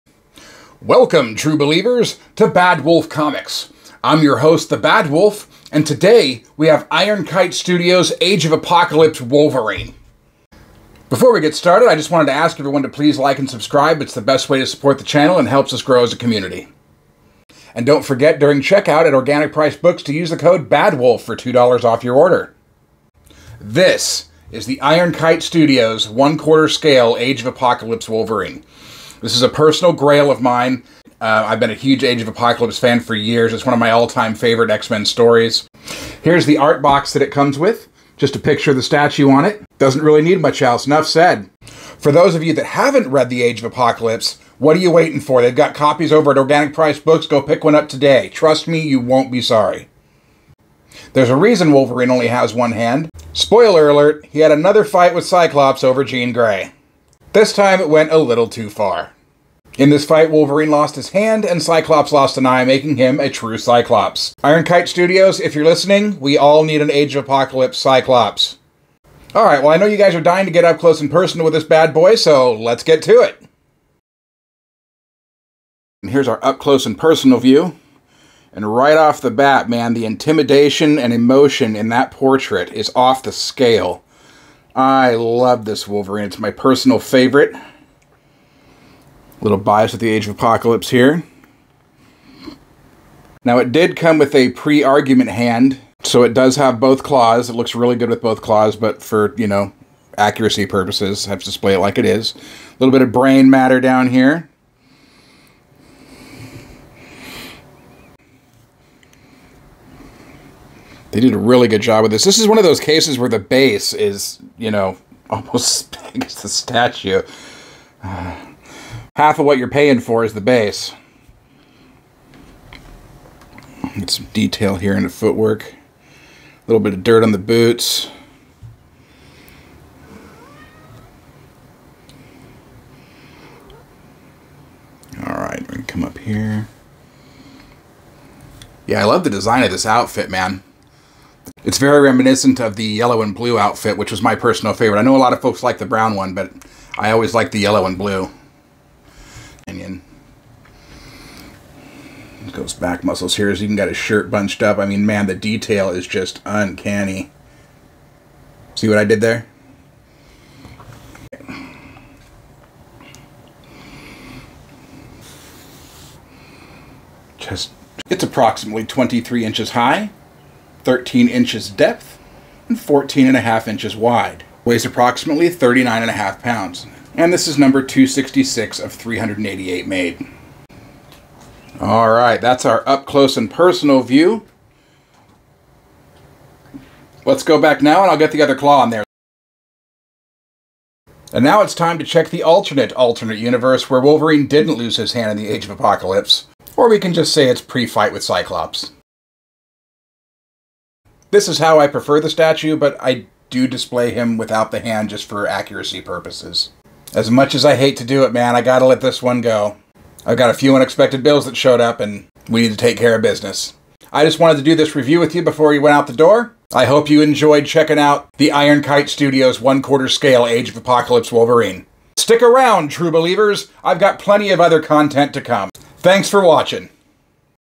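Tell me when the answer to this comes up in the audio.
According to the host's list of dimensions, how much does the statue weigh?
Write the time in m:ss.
2:55.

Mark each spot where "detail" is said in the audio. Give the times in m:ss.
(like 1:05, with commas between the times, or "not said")
2:04, 2:35.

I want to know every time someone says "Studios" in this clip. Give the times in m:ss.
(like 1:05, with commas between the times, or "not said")
0:07, 0:25, 1:04, 3:39.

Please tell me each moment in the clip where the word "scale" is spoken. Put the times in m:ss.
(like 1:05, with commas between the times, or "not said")
0:26, 1:23, 3:40.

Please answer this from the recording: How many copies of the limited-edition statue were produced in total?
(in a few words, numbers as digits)
388.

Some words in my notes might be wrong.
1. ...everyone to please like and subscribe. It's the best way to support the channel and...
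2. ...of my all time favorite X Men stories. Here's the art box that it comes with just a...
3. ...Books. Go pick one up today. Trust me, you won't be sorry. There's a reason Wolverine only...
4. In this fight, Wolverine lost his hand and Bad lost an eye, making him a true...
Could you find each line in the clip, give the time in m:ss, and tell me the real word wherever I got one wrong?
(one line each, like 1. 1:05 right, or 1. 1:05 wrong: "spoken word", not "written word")
1. 0:12 right
2. 0:33 right
3. 0:47 right
4. 0:59 wrong: "Cyclops", not "Bad".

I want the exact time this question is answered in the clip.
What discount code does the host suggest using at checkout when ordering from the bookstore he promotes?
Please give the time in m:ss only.
0:20.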